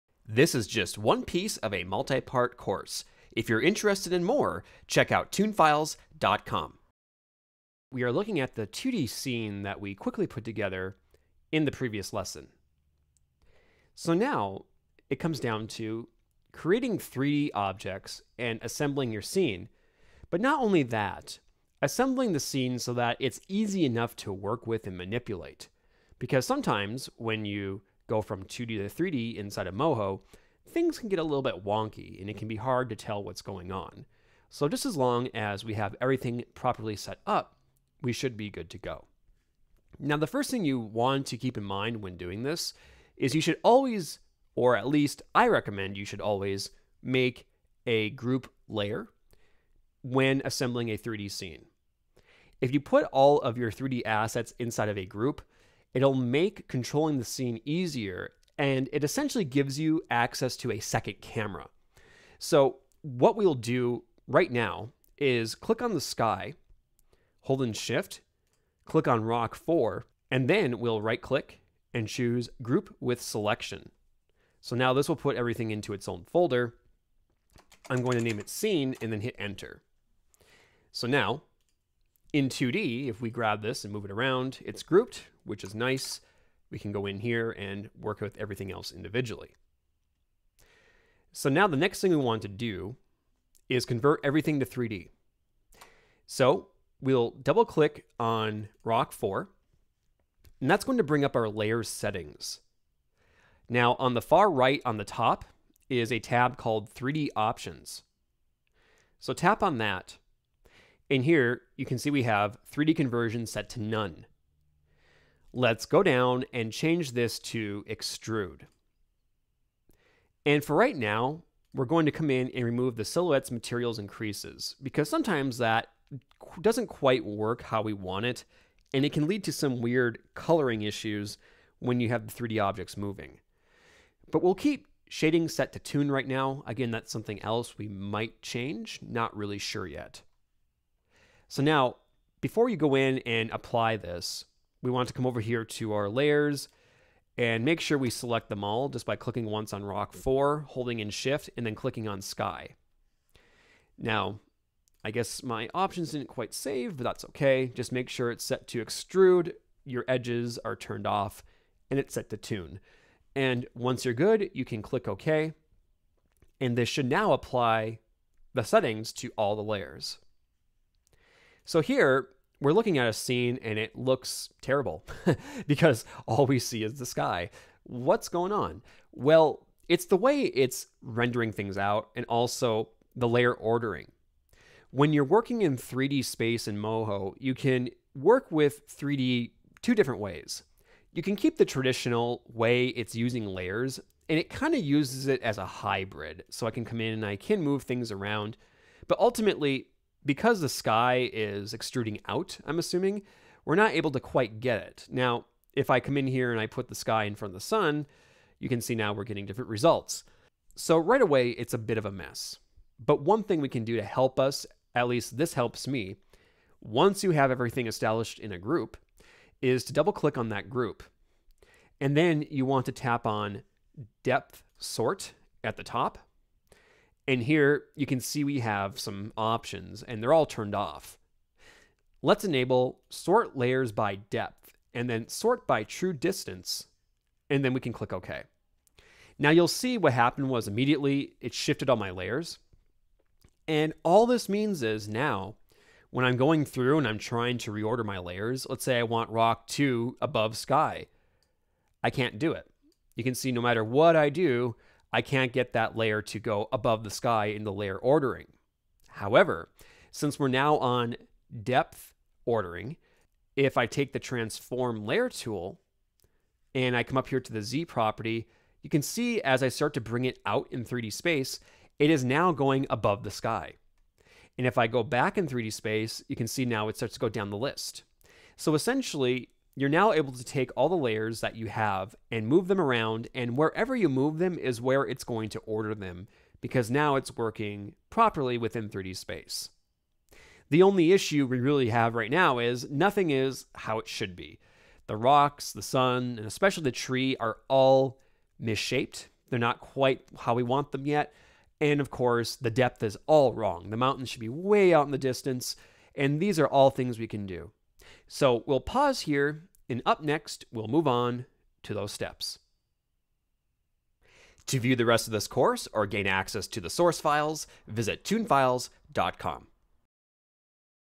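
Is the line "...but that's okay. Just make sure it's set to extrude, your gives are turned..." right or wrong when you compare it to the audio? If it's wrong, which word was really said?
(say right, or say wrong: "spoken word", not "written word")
wrong: "edges", not "gives".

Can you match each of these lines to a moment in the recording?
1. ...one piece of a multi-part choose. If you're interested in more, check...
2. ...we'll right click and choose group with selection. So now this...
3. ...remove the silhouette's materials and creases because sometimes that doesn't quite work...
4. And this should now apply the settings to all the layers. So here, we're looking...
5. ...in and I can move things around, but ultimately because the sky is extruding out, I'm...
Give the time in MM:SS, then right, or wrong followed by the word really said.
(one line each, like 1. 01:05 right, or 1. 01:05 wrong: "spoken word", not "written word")
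1. 00:00 wrong: "course", not "choose"
2. 01:10 right
3. 02:02 right
4. 02:46 right
5. 03:17 right.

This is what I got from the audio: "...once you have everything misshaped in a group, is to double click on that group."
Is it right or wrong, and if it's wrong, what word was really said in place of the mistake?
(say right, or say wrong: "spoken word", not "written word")
wrong: "established", not "misshaped".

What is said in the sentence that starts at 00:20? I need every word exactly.
But not only that, assembling the scene so that it's easy enough to work with and manipulate.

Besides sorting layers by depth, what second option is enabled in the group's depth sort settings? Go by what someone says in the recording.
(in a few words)
sort by true distance.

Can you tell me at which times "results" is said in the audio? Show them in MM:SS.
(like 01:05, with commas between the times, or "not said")
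03:29.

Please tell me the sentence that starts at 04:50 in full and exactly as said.
The only issue we really have right now is nothing is how it should be.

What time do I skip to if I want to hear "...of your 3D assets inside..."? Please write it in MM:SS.
00:53.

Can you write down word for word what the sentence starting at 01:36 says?
So we'll double click on Rock 4, and that's going to bring up our layer settings.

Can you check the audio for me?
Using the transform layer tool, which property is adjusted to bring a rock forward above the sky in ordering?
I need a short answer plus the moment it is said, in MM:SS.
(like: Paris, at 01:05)
Z property, at 04:27.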